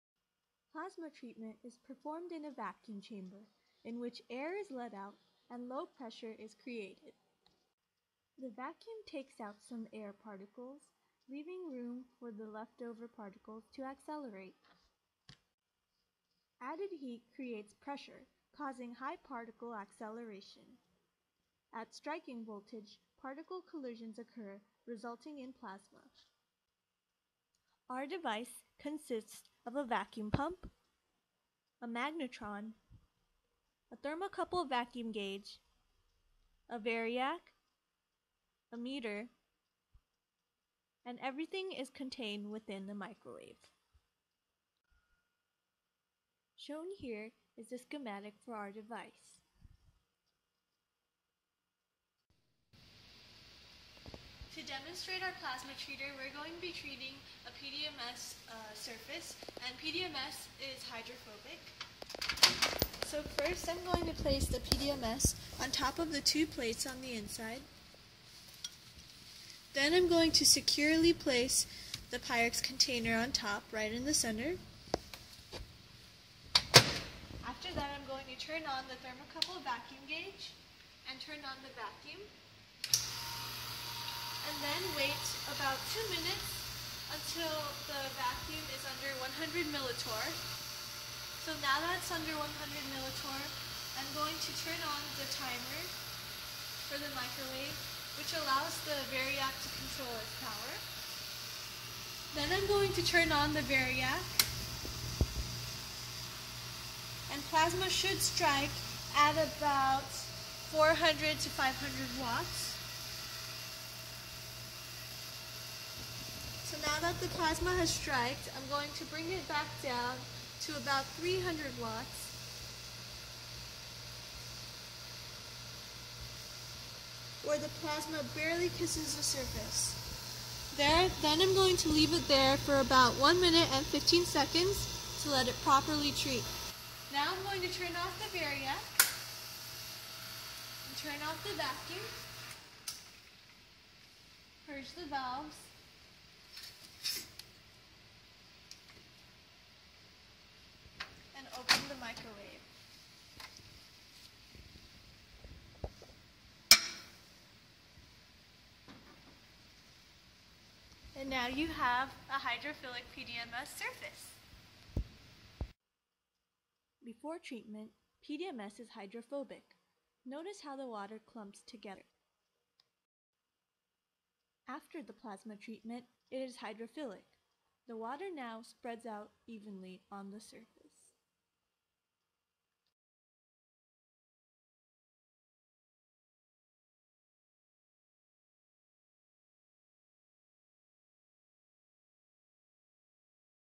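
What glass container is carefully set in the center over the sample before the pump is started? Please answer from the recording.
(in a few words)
Pyrex container.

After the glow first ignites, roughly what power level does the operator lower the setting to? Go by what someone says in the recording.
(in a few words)
300 watts.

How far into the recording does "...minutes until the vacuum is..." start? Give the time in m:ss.
1:26.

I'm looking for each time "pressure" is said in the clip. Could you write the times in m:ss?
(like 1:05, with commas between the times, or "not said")
0:05, 0:17.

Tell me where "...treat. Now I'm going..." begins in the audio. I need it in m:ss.
2:16.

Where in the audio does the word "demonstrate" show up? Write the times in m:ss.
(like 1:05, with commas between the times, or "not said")
0:54.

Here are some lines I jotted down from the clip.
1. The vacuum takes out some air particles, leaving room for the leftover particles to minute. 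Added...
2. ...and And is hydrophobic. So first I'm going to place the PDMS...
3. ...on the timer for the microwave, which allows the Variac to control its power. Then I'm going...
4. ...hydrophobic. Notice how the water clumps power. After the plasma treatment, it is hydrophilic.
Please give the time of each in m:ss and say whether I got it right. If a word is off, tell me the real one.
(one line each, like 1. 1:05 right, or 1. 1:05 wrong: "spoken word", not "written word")
1. 0:08 wrong: "accelerate", not "minute"
2. 0:59 wrong: "PDMS", not "And"
3. 1:34 right
4. 2:48 wrong: "together", not "power".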